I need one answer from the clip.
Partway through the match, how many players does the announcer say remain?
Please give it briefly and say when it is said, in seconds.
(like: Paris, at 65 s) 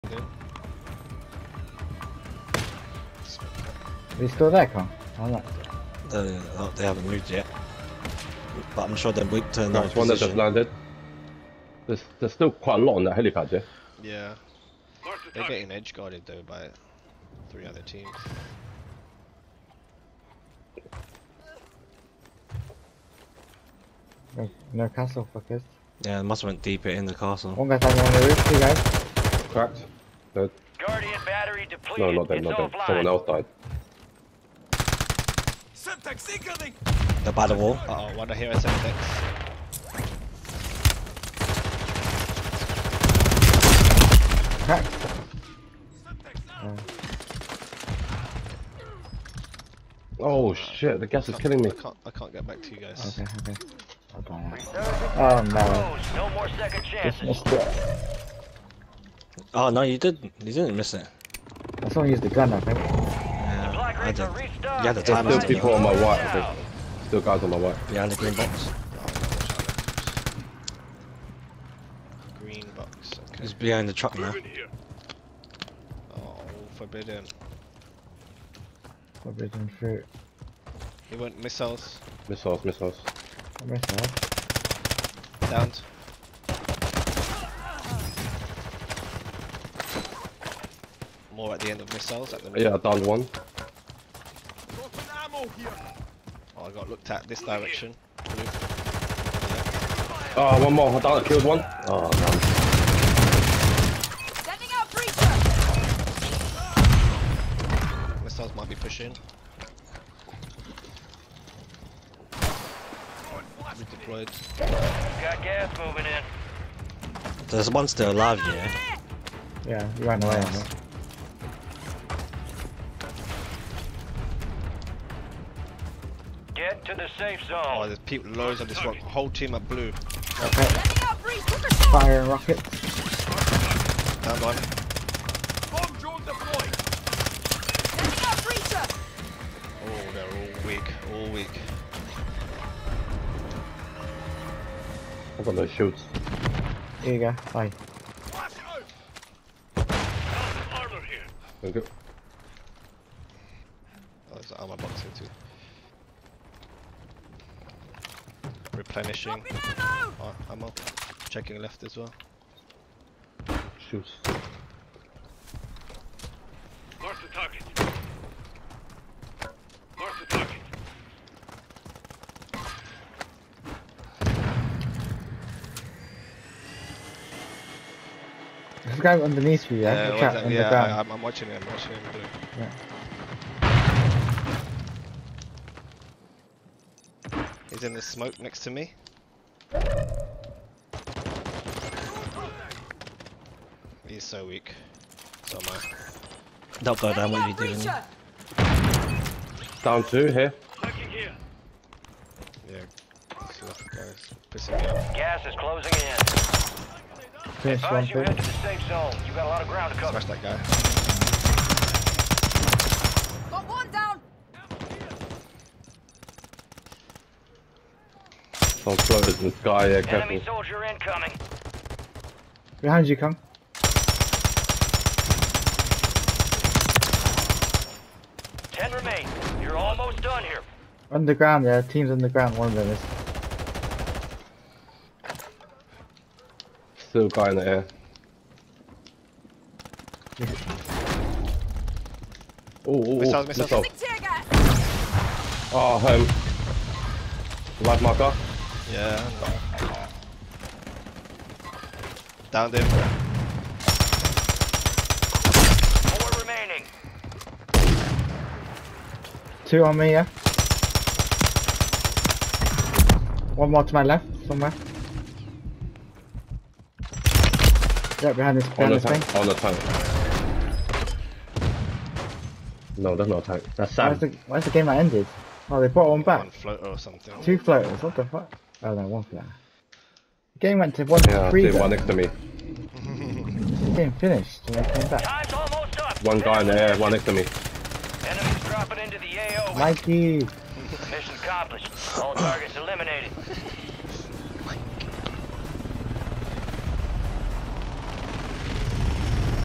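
10, at 228 s.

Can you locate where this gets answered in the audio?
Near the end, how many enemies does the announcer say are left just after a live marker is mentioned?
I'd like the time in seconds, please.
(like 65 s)
256 s.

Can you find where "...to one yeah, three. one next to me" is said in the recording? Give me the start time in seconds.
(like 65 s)
280 s.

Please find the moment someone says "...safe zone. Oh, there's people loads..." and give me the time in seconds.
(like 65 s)
127 s.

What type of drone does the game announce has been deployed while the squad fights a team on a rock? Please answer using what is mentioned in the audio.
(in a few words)
Bomb drone.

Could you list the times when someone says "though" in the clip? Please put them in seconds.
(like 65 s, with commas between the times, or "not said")
16 s.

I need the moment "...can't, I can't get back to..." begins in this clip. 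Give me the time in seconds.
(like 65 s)
51 s.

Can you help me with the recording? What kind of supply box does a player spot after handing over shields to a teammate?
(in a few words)
Armor box.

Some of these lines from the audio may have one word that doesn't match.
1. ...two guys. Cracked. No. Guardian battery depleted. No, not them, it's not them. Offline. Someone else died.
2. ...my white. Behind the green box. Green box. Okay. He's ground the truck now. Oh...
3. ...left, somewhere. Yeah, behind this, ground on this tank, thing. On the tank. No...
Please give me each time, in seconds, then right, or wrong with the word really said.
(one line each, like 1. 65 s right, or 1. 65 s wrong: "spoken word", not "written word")
1. 28 s right
2. 67 s wrong: "behind", not "ground"
3. 264 s wrong: "behind", not "ground".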